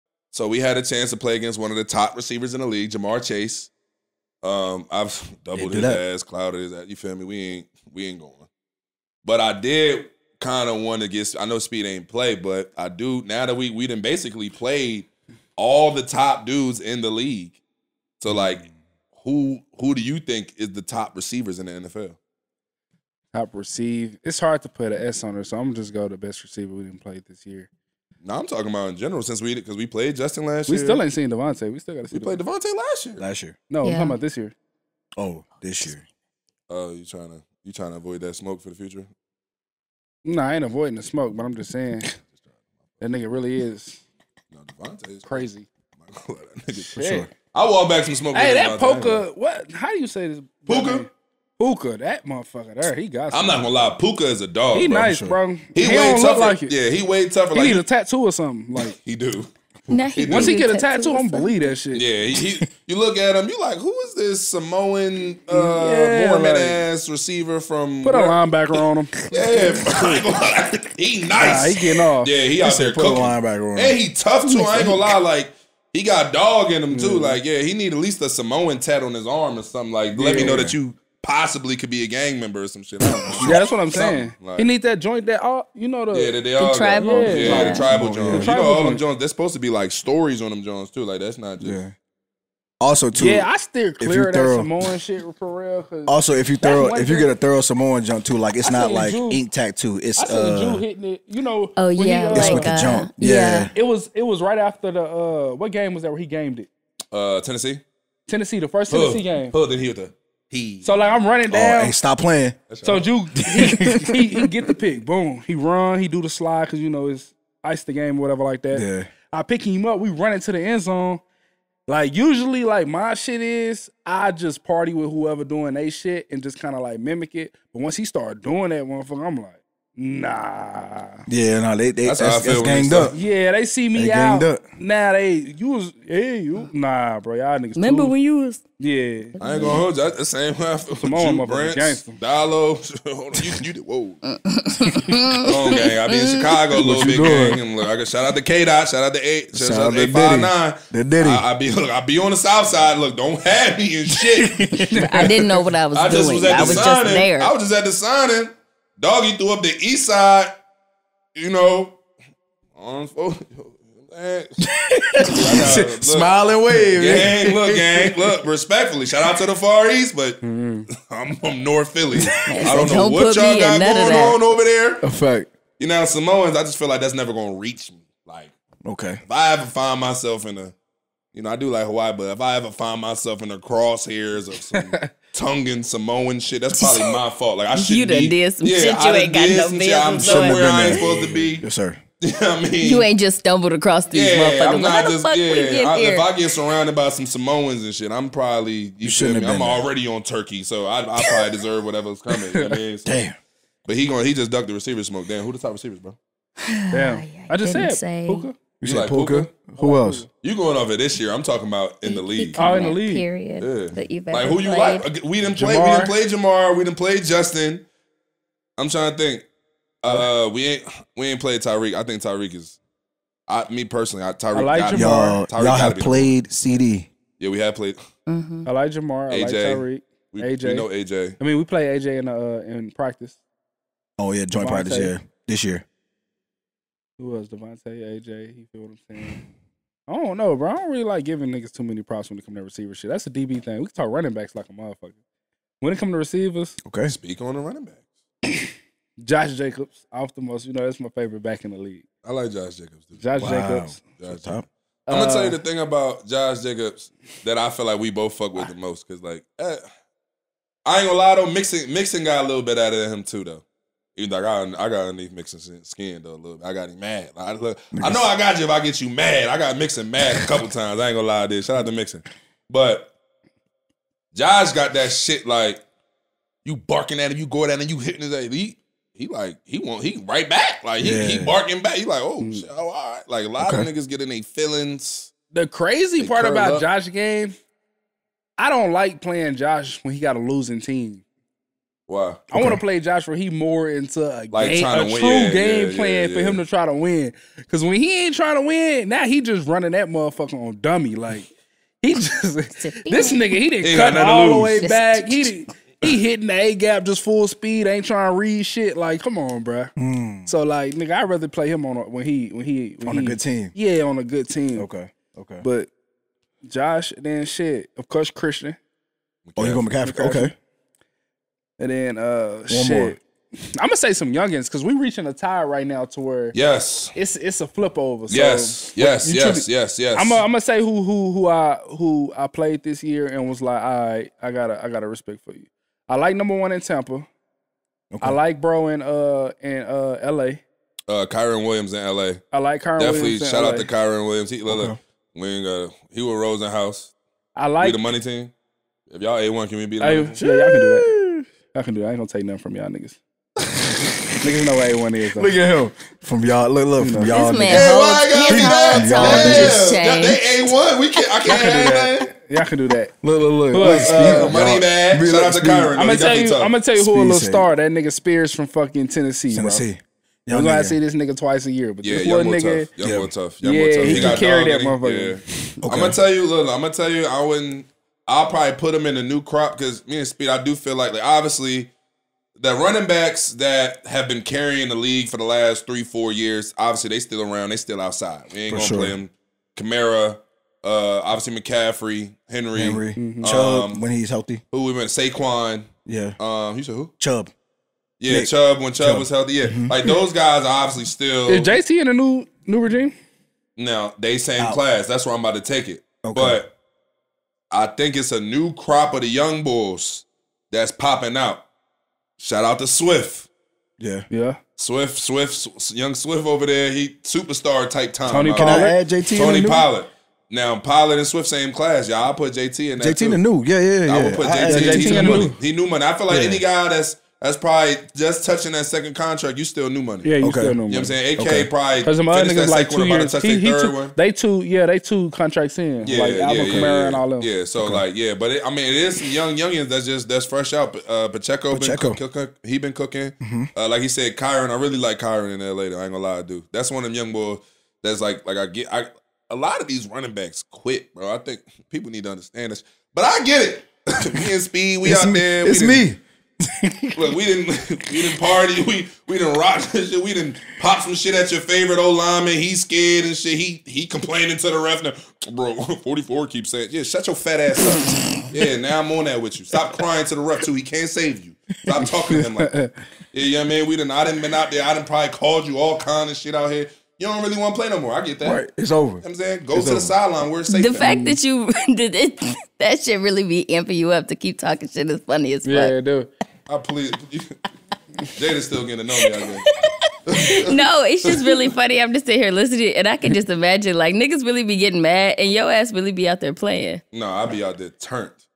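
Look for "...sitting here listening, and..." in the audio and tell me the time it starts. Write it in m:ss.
8:12.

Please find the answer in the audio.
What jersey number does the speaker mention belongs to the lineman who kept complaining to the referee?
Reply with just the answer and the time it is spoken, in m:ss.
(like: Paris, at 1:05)
44, at 7:46.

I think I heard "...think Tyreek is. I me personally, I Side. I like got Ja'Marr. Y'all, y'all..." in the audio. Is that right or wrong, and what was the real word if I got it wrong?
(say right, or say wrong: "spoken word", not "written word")
wrong: "Tyreek", not "Side".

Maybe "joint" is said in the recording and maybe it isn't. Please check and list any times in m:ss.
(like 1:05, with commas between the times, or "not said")
1:24, 1:30, 3:54.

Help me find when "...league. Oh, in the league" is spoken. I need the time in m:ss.
3:32.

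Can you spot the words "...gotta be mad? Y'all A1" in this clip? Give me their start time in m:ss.
5:58.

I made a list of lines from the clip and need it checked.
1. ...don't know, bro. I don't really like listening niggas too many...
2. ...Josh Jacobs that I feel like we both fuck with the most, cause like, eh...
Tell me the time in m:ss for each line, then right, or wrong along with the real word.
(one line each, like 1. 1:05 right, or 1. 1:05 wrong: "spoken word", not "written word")
1. 4:00 wrong: "giving", not "listening"
2. 4:16 right.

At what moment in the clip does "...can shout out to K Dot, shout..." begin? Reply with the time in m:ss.
2:27.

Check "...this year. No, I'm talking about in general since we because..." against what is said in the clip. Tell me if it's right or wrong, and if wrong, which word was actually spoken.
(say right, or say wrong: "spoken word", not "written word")
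right.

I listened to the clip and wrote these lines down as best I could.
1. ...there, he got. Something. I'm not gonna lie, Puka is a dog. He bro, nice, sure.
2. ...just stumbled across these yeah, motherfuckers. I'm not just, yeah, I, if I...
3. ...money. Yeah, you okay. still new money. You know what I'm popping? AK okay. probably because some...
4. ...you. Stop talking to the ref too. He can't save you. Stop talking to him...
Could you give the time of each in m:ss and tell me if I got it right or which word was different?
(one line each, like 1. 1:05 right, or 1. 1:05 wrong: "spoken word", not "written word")
1. 0:52 right
2. 3:13 right
3. 7:10 wrong: "saying", not "popping"
4. 7:49 wrong: "crying", not "talking".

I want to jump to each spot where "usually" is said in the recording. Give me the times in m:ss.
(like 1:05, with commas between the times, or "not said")
2:02.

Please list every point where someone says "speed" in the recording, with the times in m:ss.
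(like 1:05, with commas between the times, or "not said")
0:11, 5:07, 6:20, 7:34.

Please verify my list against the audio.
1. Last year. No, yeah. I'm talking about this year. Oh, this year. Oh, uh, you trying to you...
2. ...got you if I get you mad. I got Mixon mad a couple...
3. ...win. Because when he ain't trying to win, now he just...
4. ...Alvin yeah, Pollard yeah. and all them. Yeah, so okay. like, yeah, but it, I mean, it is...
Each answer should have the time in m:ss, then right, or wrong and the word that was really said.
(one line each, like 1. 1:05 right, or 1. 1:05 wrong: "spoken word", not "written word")
1. 0:33 right
2. 4:28 right
3. 4:56 right
4. 7:16 wrong: "Kamara", not "Pollard".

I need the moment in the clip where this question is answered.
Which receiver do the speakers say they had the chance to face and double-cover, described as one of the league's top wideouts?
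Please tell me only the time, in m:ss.
0:02.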